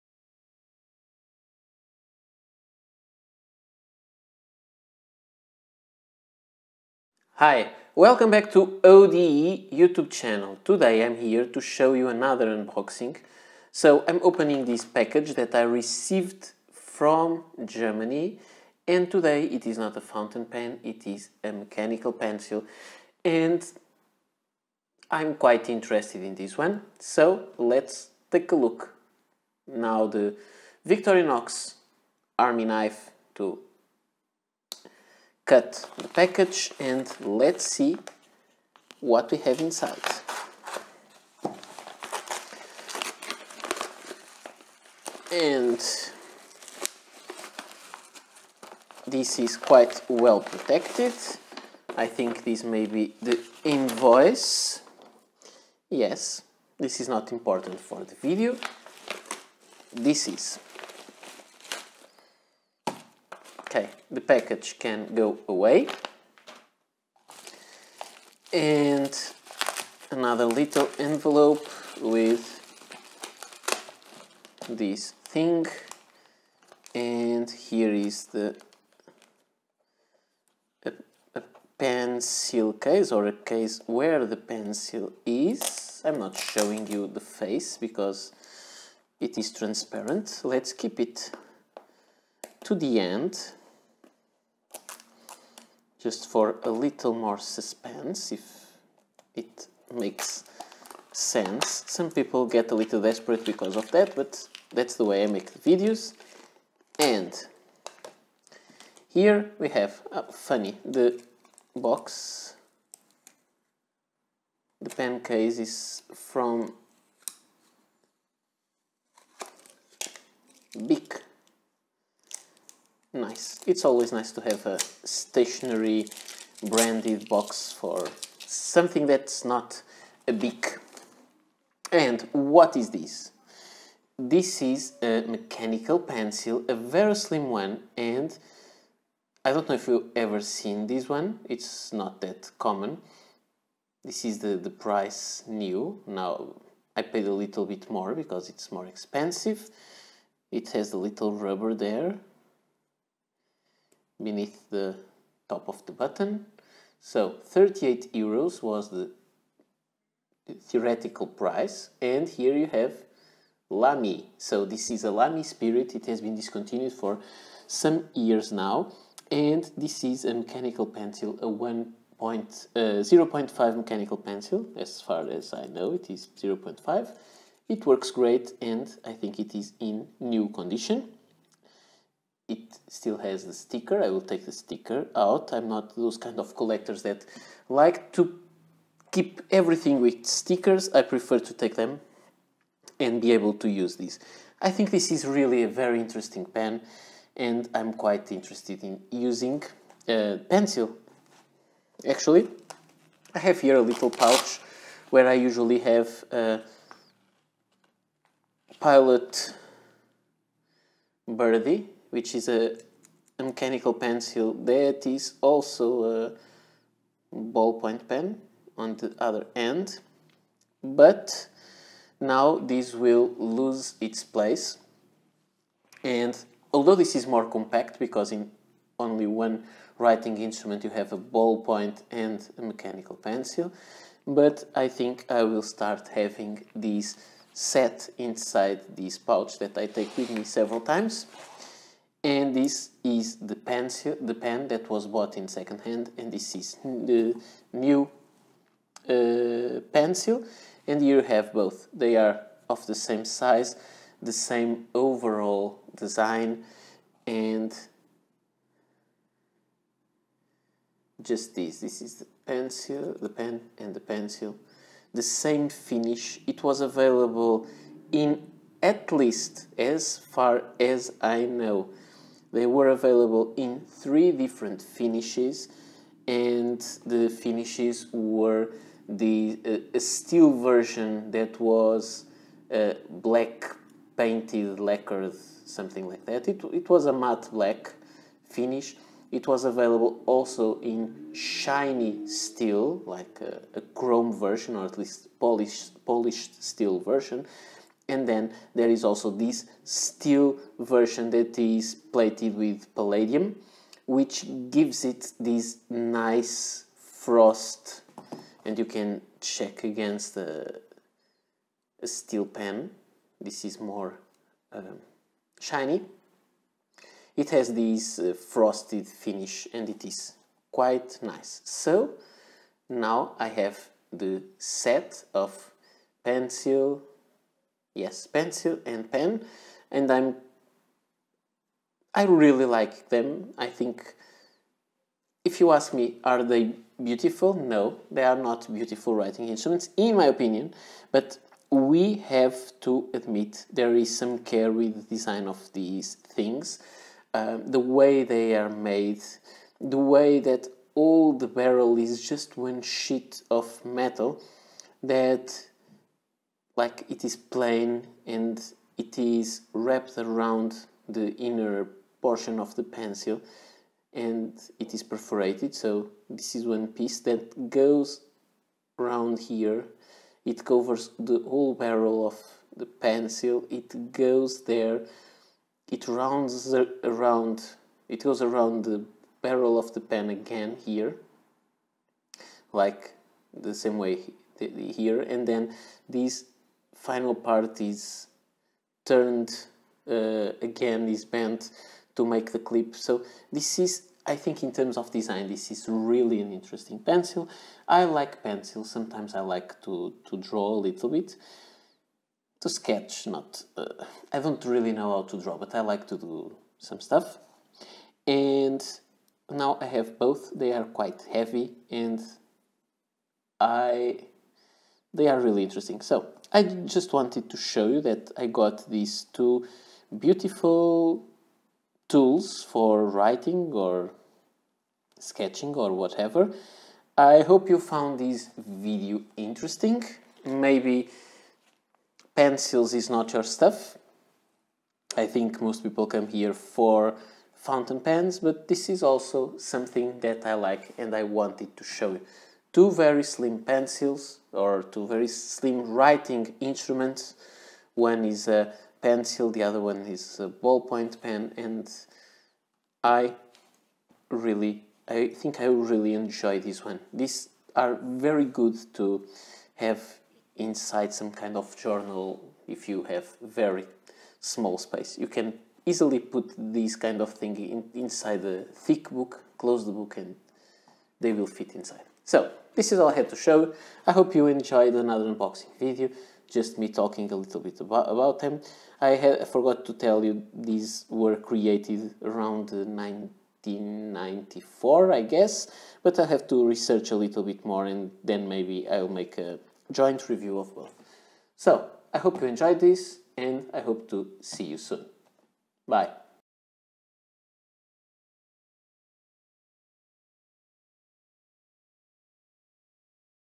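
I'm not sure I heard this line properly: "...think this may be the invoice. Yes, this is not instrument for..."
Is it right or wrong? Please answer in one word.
wrong.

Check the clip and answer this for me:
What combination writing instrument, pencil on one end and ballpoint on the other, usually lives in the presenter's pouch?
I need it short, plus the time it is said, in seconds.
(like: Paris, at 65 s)
Pilot Birdie, at 208 s.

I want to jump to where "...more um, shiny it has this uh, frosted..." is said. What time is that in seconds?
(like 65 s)
313 s.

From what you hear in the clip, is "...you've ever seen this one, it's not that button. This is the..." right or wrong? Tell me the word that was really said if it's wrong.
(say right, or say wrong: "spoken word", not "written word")
wrong: "common", not "button".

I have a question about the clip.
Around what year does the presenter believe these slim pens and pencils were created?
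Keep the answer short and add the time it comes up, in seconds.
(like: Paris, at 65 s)
1994, at 482 s.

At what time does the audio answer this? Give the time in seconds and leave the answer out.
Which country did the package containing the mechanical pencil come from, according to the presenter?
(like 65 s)
17 s.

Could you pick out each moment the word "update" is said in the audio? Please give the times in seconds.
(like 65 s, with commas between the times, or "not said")
not said.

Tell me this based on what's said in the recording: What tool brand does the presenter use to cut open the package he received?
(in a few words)
Victorinox.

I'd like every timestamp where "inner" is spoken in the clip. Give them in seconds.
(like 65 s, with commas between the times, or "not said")
361 s.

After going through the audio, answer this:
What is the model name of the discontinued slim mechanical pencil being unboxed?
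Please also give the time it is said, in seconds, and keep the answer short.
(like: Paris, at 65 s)
Lamy Spirit, at 165 s.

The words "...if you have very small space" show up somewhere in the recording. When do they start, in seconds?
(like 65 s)
462 s.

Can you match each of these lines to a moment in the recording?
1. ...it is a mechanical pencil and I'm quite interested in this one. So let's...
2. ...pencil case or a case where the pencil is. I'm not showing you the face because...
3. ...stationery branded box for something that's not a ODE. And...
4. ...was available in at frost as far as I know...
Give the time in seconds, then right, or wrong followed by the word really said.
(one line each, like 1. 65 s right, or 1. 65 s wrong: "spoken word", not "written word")
1. 20 s right
2. 81 s right
3. 125 s wrong: "Bic", not "ODE"
4. 266 s wrong: "least", not "frost".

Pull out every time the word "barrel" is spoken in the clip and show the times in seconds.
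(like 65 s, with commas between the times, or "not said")
351 s, 371 s, 379 s.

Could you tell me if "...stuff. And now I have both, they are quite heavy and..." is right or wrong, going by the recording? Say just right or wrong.
right.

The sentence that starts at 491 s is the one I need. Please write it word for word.
So, I hope you enjoyed this and I hope to see you soon.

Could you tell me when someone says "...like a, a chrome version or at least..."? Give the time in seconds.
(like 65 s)
293 s.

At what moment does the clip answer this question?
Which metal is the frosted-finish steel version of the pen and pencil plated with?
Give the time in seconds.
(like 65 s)
302 s.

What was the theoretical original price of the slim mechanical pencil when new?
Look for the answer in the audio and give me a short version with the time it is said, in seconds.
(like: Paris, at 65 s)
38 euros, at 157 s.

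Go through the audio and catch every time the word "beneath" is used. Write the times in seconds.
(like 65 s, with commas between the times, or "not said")
154 s.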